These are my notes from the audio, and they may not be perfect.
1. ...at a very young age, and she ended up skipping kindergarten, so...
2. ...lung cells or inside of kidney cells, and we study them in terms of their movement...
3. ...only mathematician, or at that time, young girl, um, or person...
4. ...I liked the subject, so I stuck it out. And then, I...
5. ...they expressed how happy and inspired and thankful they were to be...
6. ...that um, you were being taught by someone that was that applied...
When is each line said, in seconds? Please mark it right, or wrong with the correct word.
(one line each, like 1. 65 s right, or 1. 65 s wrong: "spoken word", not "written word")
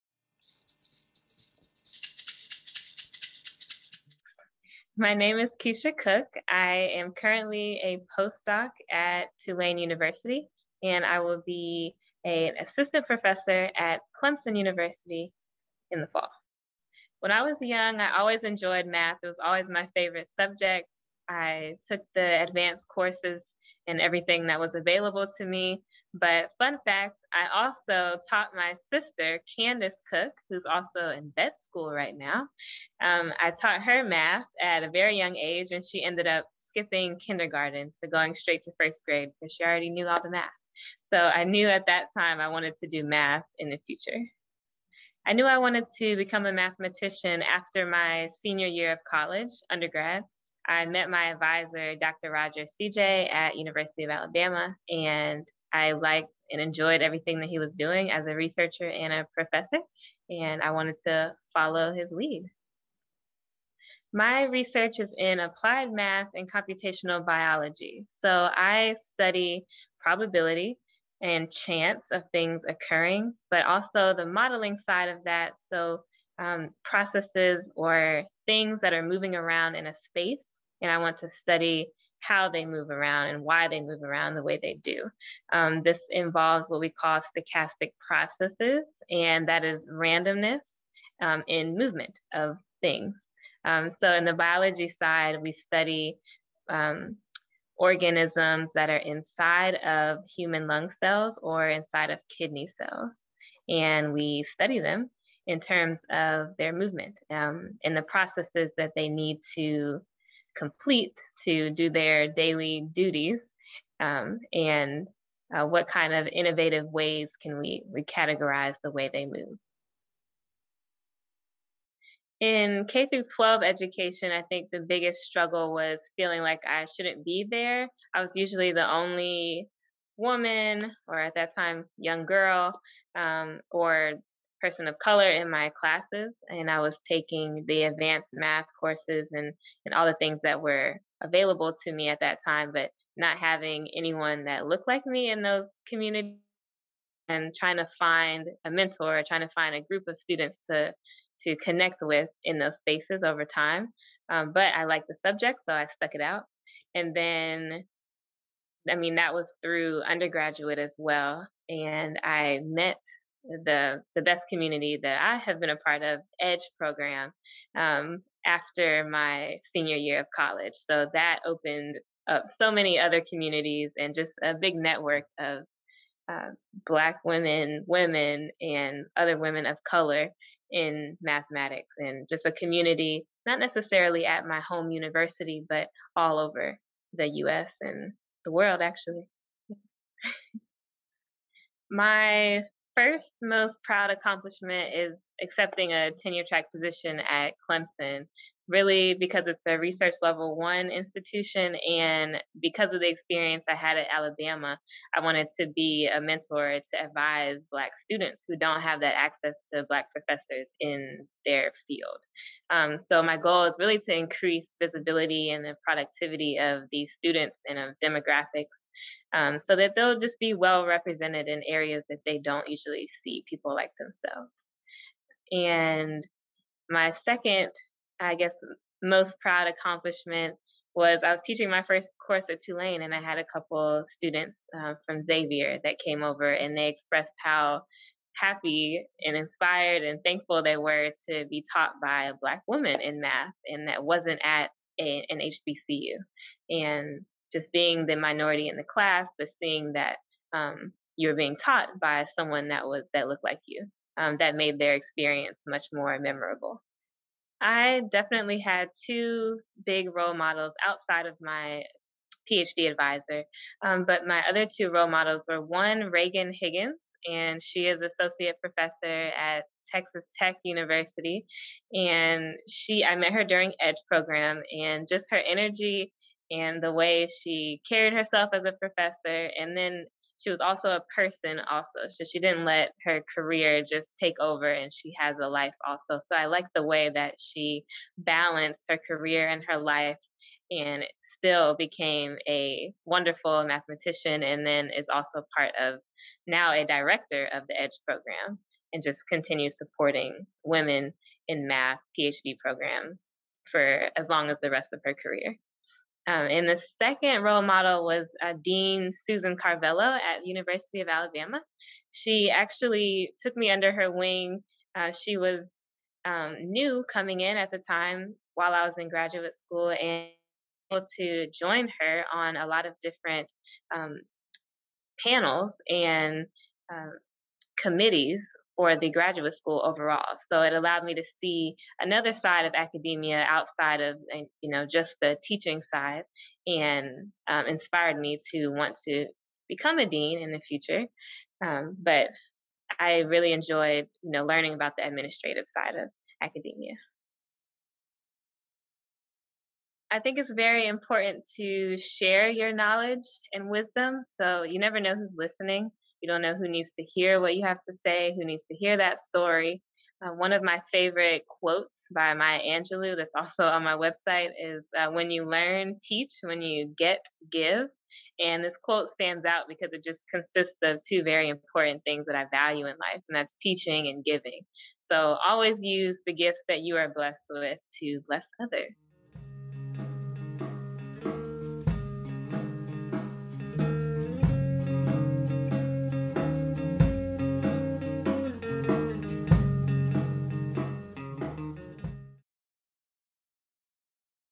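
1. 34 s right
2. 100 s right
3. 128 s wrong: "woman", not "mathematician"
4. 154 s right
5. 236 s right
6. 249 s wrong: "looked", not "applied".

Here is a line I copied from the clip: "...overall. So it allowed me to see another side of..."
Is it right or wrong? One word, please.
right.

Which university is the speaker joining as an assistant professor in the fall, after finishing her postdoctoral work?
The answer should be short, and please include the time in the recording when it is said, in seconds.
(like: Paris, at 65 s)
Clemson University, at 14 s.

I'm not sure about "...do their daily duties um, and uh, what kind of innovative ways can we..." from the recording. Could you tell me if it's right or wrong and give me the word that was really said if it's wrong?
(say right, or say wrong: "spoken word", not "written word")
right.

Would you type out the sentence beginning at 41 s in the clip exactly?
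So I knew at that time I wanted to do math in the future.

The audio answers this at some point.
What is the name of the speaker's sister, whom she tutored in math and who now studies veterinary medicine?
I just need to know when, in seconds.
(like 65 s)
29 s.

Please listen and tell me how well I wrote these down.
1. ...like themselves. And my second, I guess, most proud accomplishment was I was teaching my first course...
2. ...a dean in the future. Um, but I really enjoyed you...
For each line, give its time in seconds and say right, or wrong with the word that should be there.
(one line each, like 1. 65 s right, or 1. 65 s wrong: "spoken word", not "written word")
1. 223 s right
2. 339 s right.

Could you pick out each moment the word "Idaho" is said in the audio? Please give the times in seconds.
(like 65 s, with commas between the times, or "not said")
not said.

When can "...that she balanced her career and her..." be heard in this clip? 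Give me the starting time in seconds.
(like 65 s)
287 s.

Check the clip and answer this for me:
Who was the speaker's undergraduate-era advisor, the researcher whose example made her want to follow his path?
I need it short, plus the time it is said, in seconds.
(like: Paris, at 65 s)
Roger Sidje, at 51 s.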